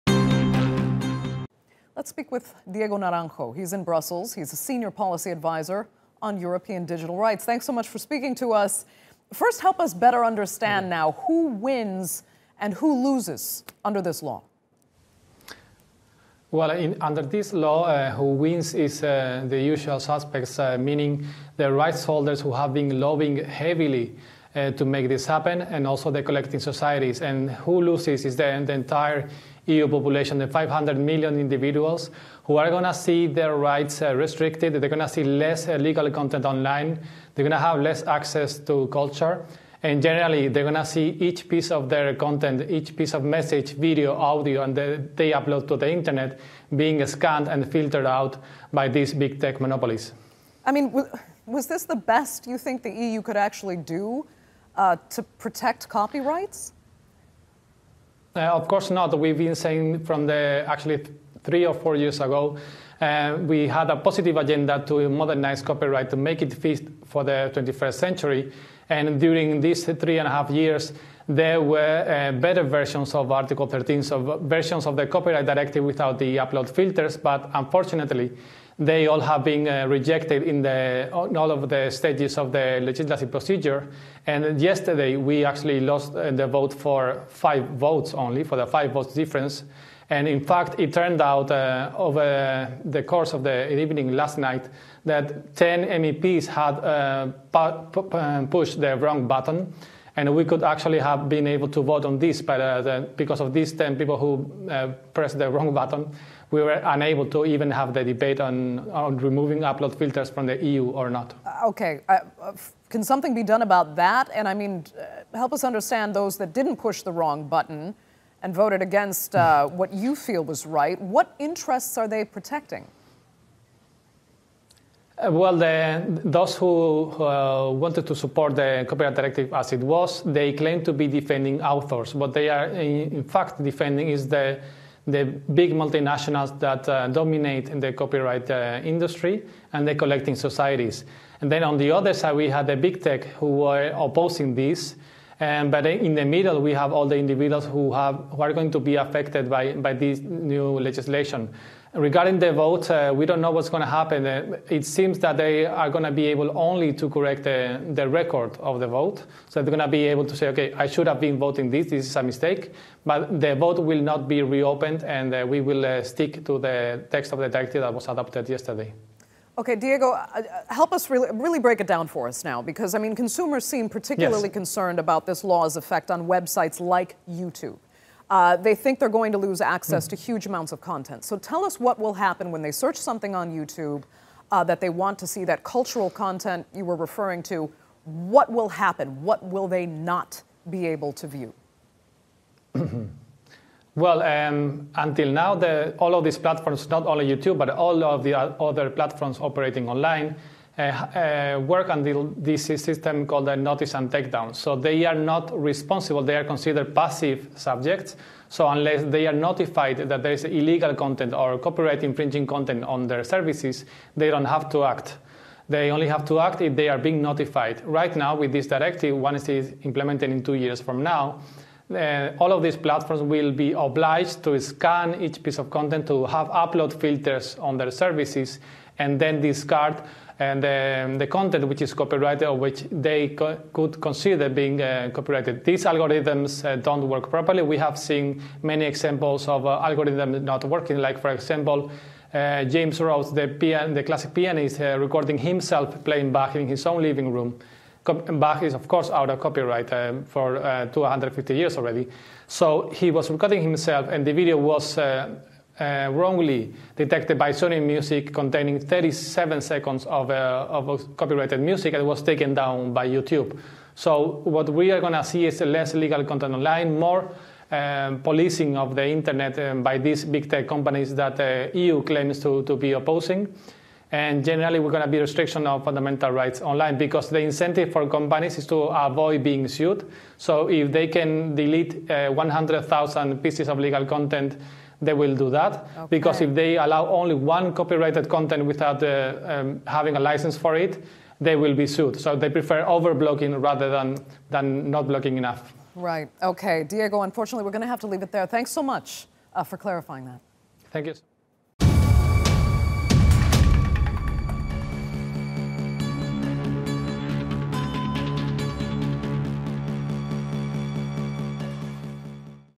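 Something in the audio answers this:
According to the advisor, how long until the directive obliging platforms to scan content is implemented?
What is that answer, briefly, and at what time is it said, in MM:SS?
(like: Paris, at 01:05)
2 years, at 03:40.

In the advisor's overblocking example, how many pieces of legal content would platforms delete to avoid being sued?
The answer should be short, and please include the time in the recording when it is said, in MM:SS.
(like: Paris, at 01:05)
100,000, at 04:42.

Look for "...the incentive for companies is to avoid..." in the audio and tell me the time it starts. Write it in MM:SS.
04:37.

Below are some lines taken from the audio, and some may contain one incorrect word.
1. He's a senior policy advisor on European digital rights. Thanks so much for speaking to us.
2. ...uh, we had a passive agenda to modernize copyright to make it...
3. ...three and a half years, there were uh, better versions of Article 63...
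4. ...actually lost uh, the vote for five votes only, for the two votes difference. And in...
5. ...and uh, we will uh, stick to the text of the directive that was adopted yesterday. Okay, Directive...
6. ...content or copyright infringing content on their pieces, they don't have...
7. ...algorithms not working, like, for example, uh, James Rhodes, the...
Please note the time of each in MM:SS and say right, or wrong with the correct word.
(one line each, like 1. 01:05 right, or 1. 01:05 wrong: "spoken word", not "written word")
1. 00:04 right
2. 01:03 wrong: "positive", not "passive"
3. 01:09 wrong: "13", not "63"
4. 01:25 wrong: "five", not "two"
5. 02:45 wrong: "Diego", not "Directive"
6. 03:30 wrong: "services", not "pieces"
7. 03:59 right.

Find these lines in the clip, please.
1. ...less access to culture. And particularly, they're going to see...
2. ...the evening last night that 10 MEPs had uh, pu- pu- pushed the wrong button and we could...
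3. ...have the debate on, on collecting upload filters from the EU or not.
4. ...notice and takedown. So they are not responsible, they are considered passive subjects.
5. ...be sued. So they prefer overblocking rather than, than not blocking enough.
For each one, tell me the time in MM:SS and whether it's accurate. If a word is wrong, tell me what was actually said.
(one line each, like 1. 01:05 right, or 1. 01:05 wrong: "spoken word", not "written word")
1. 00:37 wrong: "generally", not "particularly"
2. 01:33 right
3. 01:47 wrong: "removing", not "collecting"
4. 03:23 right
5. 04:51 right.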